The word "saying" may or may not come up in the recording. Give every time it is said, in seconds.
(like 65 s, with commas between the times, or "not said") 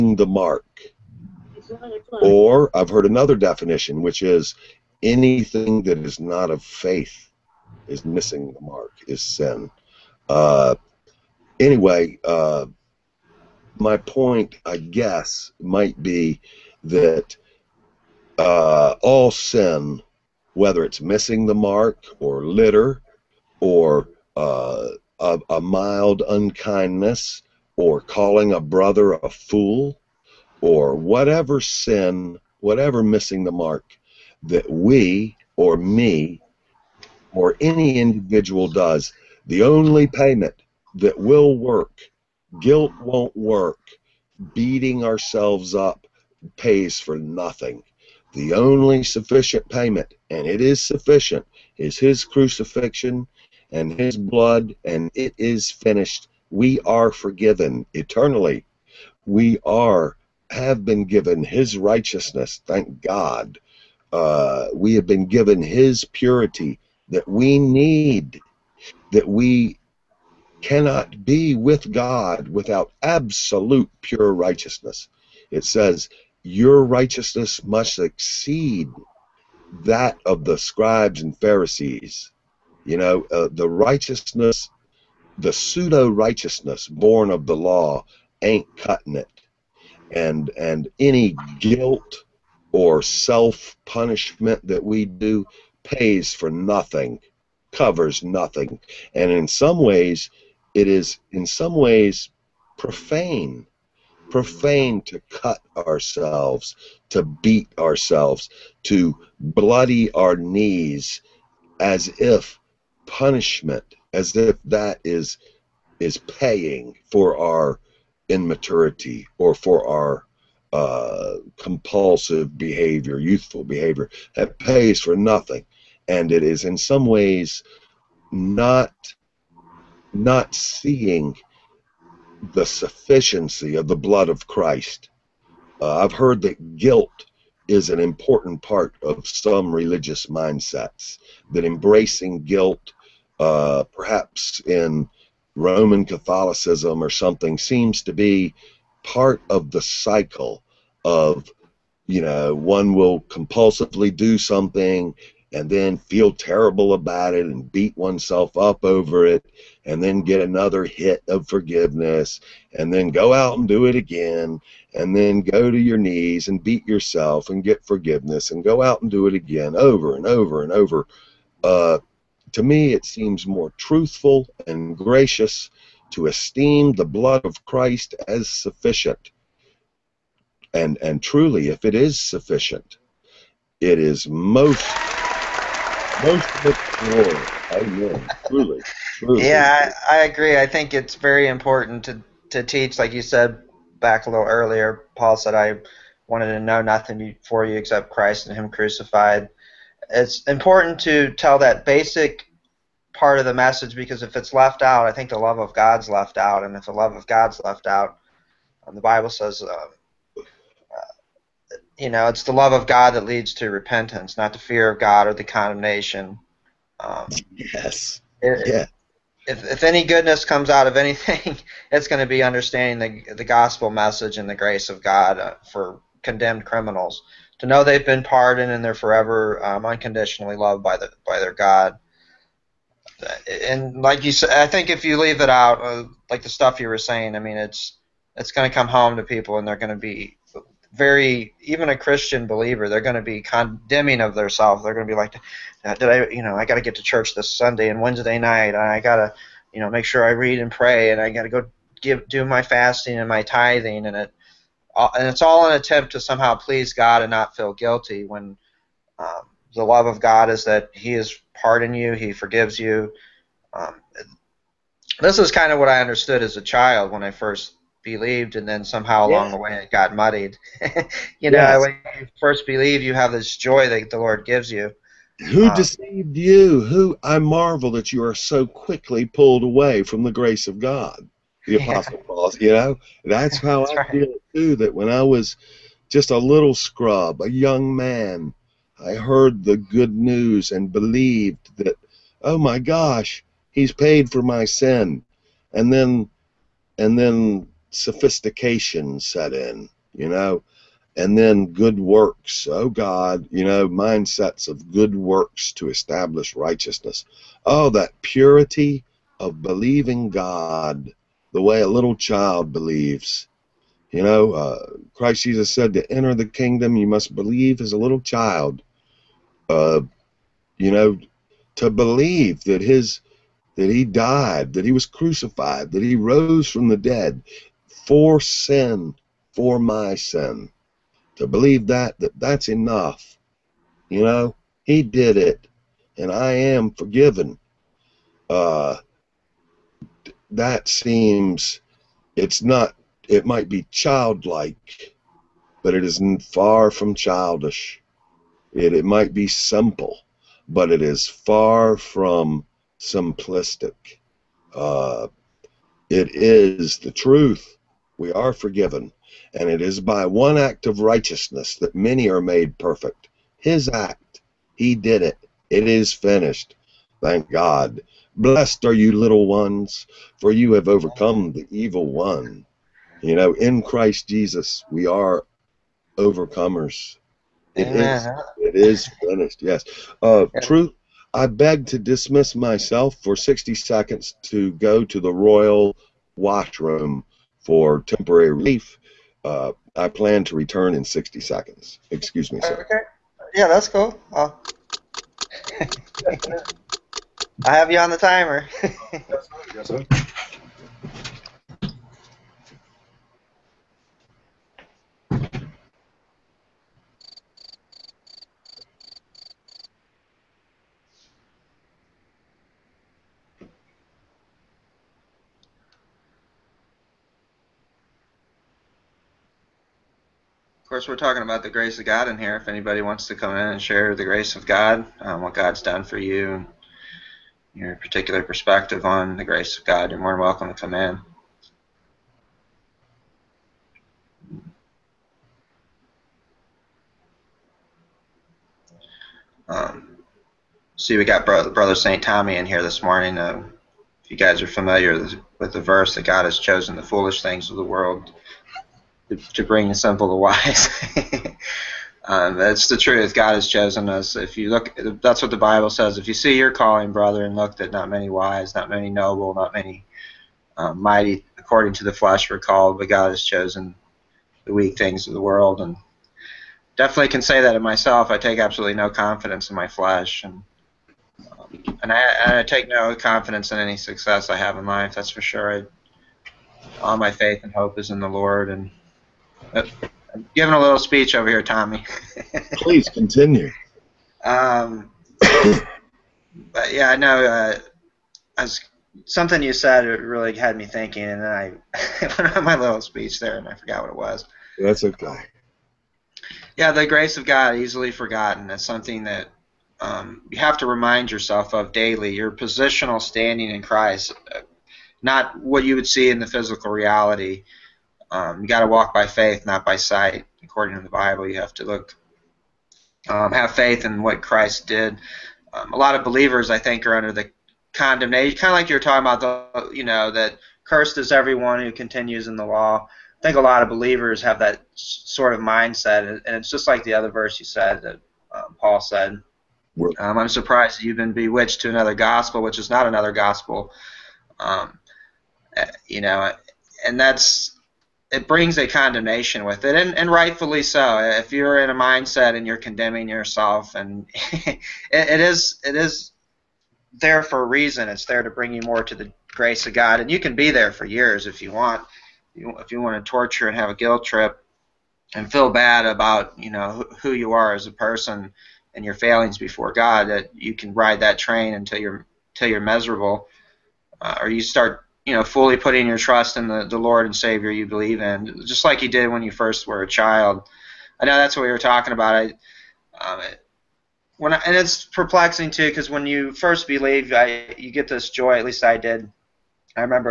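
236 s.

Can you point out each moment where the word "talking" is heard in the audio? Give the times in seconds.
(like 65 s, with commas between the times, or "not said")
421 s, 519 s, 571 s.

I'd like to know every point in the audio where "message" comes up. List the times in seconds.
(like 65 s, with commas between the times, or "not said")
203 s, 223 s.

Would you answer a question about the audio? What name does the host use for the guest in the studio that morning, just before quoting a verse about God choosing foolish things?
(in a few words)
Brother St. Tommy.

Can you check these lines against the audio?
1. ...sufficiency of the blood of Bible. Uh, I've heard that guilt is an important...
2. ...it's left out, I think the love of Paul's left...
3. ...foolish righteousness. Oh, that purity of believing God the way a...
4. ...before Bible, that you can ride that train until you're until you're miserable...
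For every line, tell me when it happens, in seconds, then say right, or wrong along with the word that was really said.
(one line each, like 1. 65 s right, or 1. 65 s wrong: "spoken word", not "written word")
1. 132 s wrong: "Christ", not "Bible"
2. 204 s wrong: "God", not "Paul"
3. 305 s wrong: "establish", not "foolish"
4. 559 s wrong: "God", not "Bible".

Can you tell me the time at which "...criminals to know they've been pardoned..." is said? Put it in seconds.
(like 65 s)
226 s.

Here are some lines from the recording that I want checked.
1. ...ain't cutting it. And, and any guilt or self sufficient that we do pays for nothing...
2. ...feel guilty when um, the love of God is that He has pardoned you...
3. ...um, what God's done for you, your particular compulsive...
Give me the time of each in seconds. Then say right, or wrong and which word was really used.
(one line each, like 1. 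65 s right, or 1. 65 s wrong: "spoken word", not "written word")
1. 88 s wrong: "punishment", not "sufficient"
2. 257 s right
3. 425 s wrong: "perspective", not "compulsive".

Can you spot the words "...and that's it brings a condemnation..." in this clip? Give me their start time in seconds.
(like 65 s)
537 s.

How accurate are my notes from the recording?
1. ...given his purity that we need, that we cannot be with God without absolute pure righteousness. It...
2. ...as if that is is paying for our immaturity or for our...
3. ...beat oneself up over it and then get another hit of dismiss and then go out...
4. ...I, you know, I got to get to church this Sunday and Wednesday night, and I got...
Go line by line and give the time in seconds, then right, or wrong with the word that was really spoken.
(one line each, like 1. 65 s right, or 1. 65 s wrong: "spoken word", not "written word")
1. 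65 s right
2. 114 s right
3. 157 s wrong: "forgiveness", not "dismiss"
4. 246 s right.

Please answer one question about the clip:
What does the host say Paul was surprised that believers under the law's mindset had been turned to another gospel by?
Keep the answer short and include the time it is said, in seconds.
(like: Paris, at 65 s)
bewitched, at 531 s.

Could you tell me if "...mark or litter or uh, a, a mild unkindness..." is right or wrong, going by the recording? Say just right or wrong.
right.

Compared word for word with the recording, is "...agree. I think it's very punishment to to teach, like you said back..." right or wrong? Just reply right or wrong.
wrong.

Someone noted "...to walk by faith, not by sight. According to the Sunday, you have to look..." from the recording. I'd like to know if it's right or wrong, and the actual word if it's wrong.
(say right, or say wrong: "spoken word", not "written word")
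wrong: "Bible", not "Sunday".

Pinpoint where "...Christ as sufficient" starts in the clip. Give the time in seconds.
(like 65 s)
177 s.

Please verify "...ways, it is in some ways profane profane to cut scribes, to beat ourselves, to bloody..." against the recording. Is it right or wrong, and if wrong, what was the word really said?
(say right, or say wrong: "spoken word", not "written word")
wrong: "ourselves", not "scribes".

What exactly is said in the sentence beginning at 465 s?
And definitely can say that of myself.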